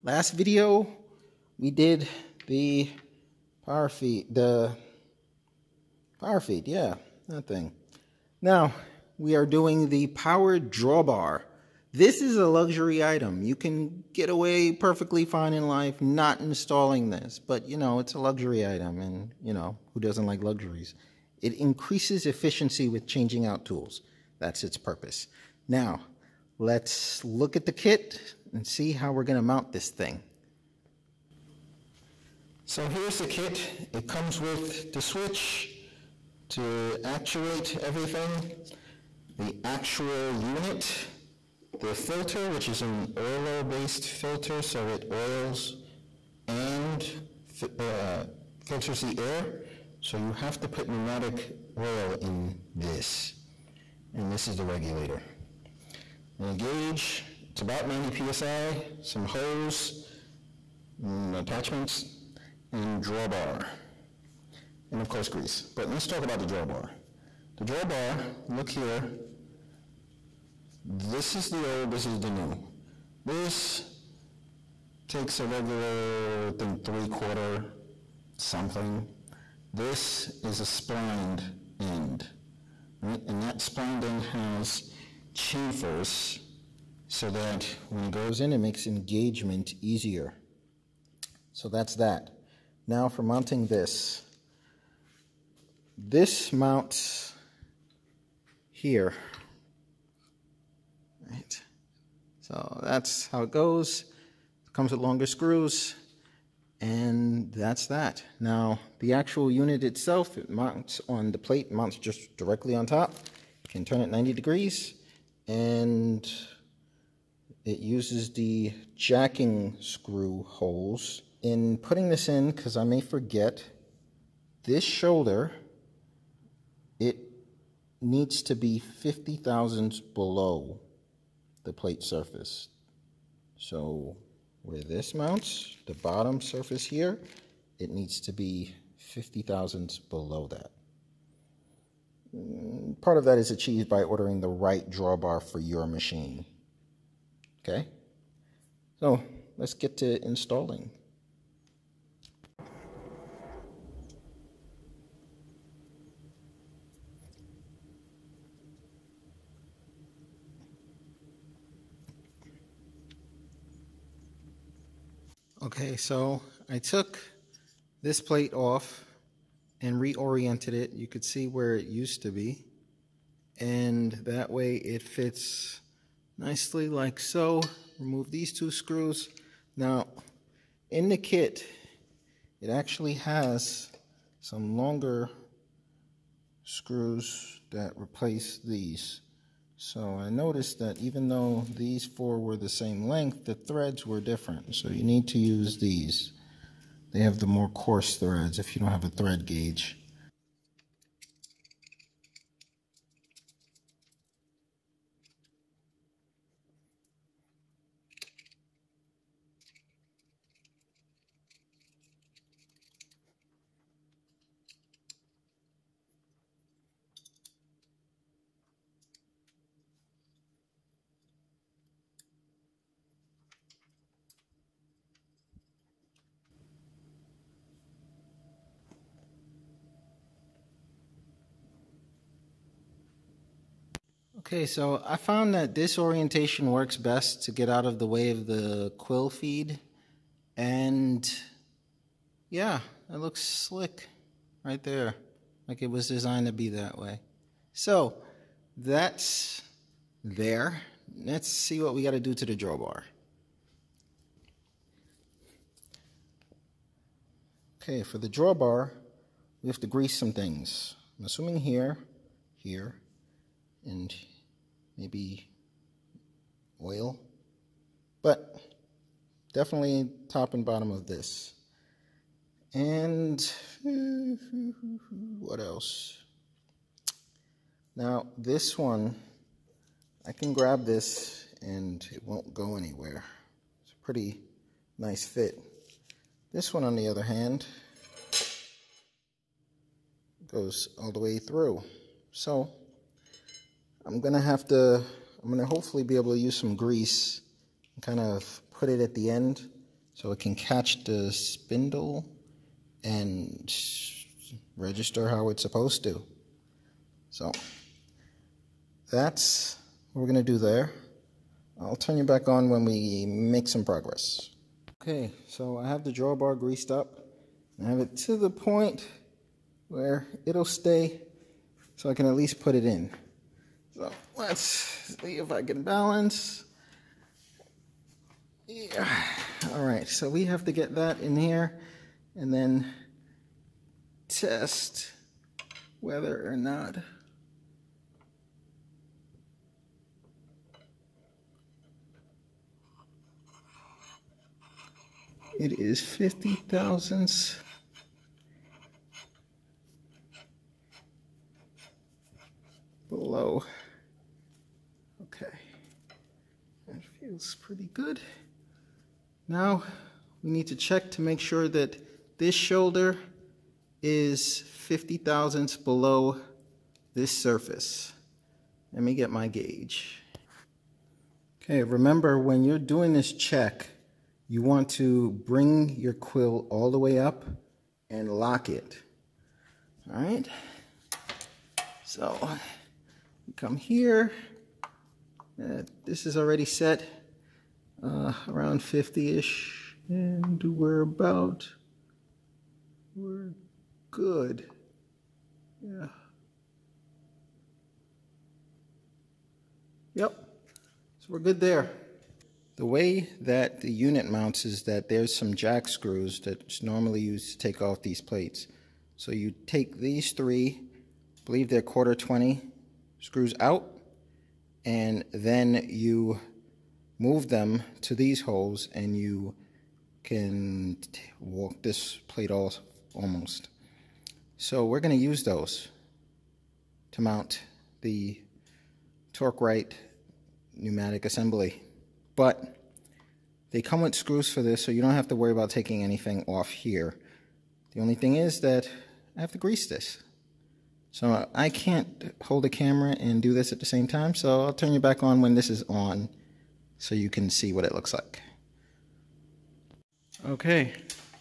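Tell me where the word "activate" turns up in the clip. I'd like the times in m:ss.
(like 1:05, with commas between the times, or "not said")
not said.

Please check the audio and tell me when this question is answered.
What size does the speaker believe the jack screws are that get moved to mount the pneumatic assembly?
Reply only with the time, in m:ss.
6:51.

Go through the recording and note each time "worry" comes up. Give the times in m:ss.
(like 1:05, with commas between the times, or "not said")
7:15.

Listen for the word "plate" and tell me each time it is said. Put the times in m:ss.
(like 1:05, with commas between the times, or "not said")
1:51, 2:11, 2:48, 6:48, 7:02.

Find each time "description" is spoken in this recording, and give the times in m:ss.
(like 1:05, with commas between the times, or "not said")
not said.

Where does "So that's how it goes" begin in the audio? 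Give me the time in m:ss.
1:42.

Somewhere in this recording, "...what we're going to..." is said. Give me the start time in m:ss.
5:10.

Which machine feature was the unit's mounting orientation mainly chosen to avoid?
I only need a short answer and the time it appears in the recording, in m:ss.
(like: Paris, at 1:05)
quill feed, at 3:58.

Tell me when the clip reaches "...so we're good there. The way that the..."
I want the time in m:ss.
6:41.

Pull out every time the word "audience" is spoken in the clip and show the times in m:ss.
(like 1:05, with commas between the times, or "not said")
not said.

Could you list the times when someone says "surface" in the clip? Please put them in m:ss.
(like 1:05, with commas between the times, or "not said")
2:12, 2:16, 6:07.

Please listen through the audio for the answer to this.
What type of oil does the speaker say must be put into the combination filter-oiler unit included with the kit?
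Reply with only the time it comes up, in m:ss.
0:50.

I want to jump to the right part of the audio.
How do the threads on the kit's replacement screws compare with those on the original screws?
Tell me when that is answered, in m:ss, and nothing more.
3:17.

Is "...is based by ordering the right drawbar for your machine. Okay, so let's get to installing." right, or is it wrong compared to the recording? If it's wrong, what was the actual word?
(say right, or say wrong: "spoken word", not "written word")
wrong: "achieved", not "based".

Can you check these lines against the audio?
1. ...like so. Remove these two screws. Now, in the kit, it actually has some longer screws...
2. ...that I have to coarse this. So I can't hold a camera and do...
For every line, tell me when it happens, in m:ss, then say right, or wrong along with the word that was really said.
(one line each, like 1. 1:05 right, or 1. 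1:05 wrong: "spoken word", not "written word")
1. 2:56 right
2. 7:18 wrong: "grease", not "coarse".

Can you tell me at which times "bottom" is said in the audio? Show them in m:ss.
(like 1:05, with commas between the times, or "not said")
2:15, 4:30.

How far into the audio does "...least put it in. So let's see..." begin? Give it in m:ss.
5:22.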